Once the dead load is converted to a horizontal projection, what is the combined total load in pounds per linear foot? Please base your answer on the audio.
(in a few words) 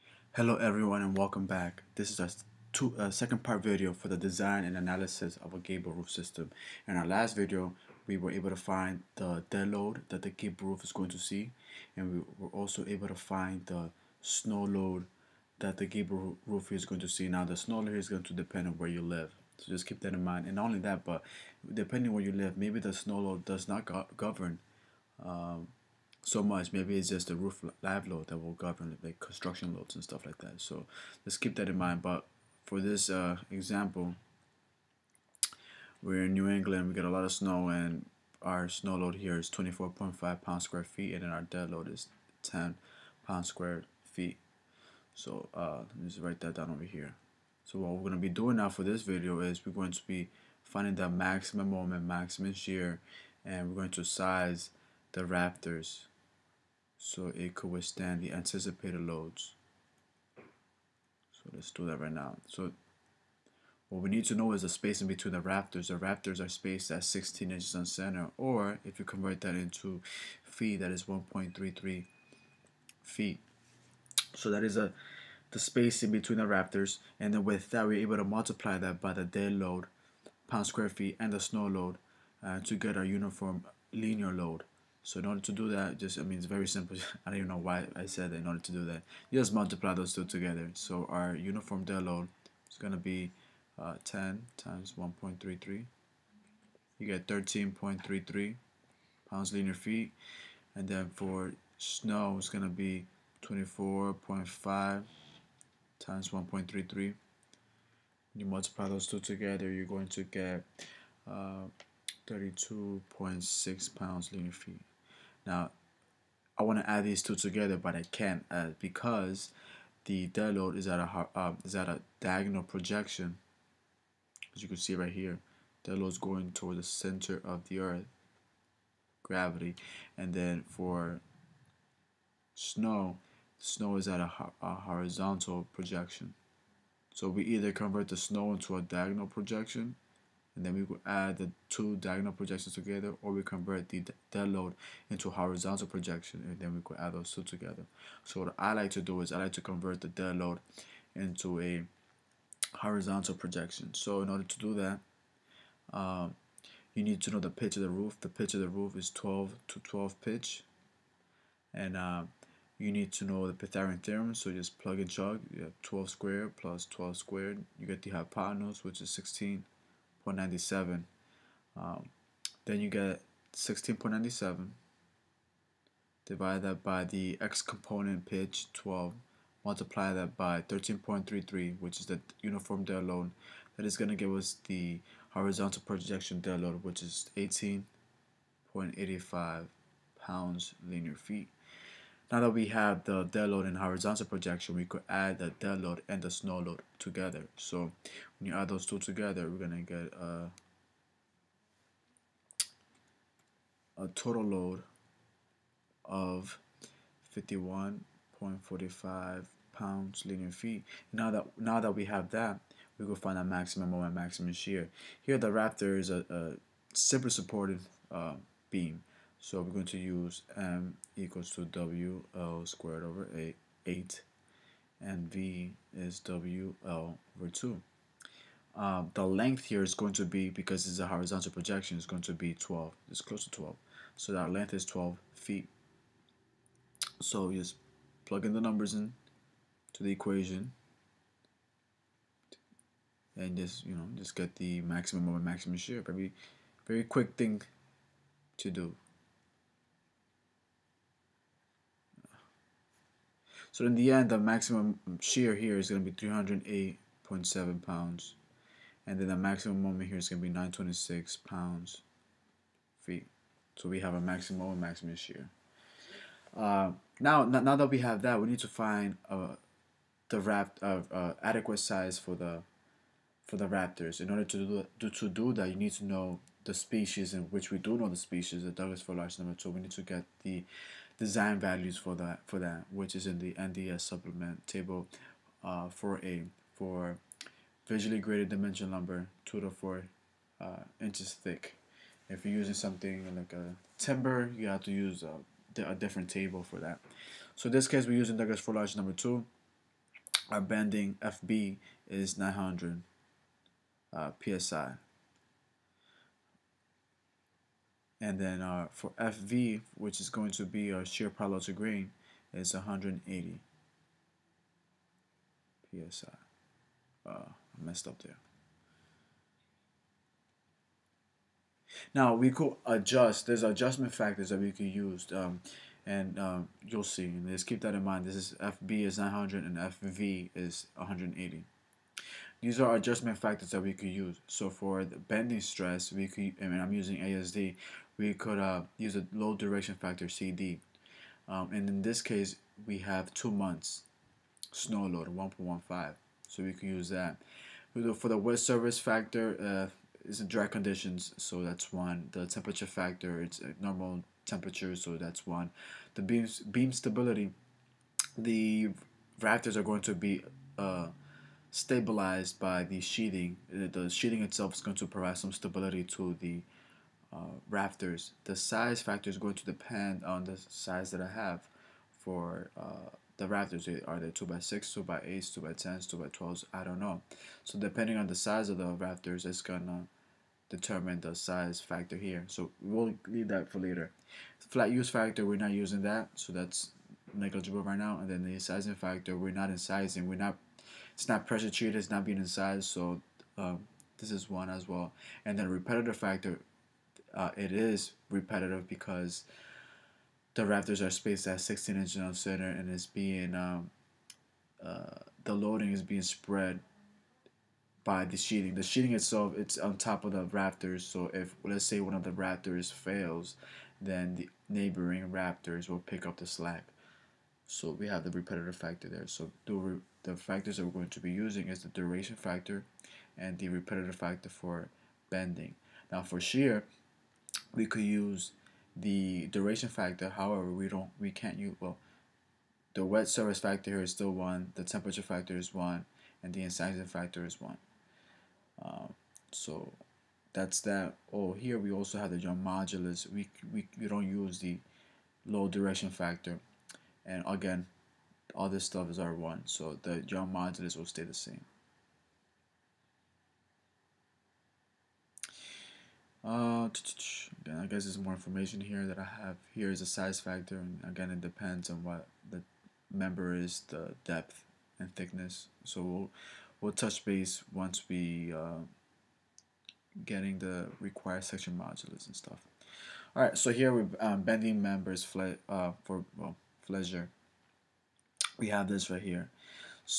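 51.45.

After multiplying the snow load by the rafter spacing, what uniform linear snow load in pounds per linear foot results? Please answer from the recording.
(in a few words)
32.6.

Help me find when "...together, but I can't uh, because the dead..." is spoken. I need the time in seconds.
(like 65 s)
117 s.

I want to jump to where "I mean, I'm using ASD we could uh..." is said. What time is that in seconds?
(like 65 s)
336 s.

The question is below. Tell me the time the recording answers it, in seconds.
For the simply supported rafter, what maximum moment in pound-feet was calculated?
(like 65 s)
260 s.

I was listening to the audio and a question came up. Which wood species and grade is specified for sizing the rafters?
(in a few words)
Douglas fir larch number 2.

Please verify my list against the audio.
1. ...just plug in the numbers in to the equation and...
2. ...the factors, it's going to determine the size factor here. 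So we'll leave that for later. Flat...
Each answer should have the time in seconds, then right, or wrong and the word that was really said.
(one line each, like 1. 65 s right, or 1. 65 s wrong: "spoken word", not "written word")
1. 237 s right
2. 378 s wrong: "rafters", not "factors".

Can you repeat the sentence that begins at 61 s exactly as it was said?
So let's do that right now.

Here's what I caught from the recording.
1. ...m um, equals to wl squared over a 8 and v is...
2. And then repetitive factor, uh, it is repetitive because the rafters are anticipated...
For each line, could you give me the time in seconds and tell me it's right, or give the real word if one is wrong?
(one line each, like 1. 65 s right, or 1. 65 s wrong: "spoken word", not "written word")
1. 220 s right
2. 395 s wrong: "spaced", not "anticipated".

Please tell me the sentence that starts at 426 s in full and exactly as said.
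Now for shear, we could use the duration factor.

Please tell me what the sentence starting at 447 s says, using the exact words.
And again, all this stuff is R1, so the drum modulus will stay the same.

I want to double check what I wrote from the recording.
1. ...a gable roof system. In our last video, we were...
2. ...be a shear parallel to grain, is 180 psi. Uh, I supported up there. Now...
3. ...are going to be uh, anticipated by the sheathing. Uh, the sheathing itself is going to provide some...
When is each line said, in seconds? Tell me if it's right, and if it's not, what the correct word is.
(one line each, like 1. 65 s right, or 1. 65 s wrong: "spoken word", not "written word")
1. 5 s right
2. 310 s wrong: "messed", not "supported"
3. 359 s wrong: "stabilized", not "anticipated".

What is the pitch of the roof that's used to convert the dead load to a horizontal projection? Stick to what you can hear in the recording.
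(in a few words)
12 to 12.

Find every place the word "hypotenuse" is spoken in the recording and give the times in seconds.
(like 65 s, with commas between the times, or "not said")
168 s.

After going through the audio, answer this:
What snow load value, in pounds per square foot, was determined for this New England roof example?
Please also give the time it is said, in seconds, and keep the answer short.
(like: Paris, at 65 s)
24.5, at 39 s.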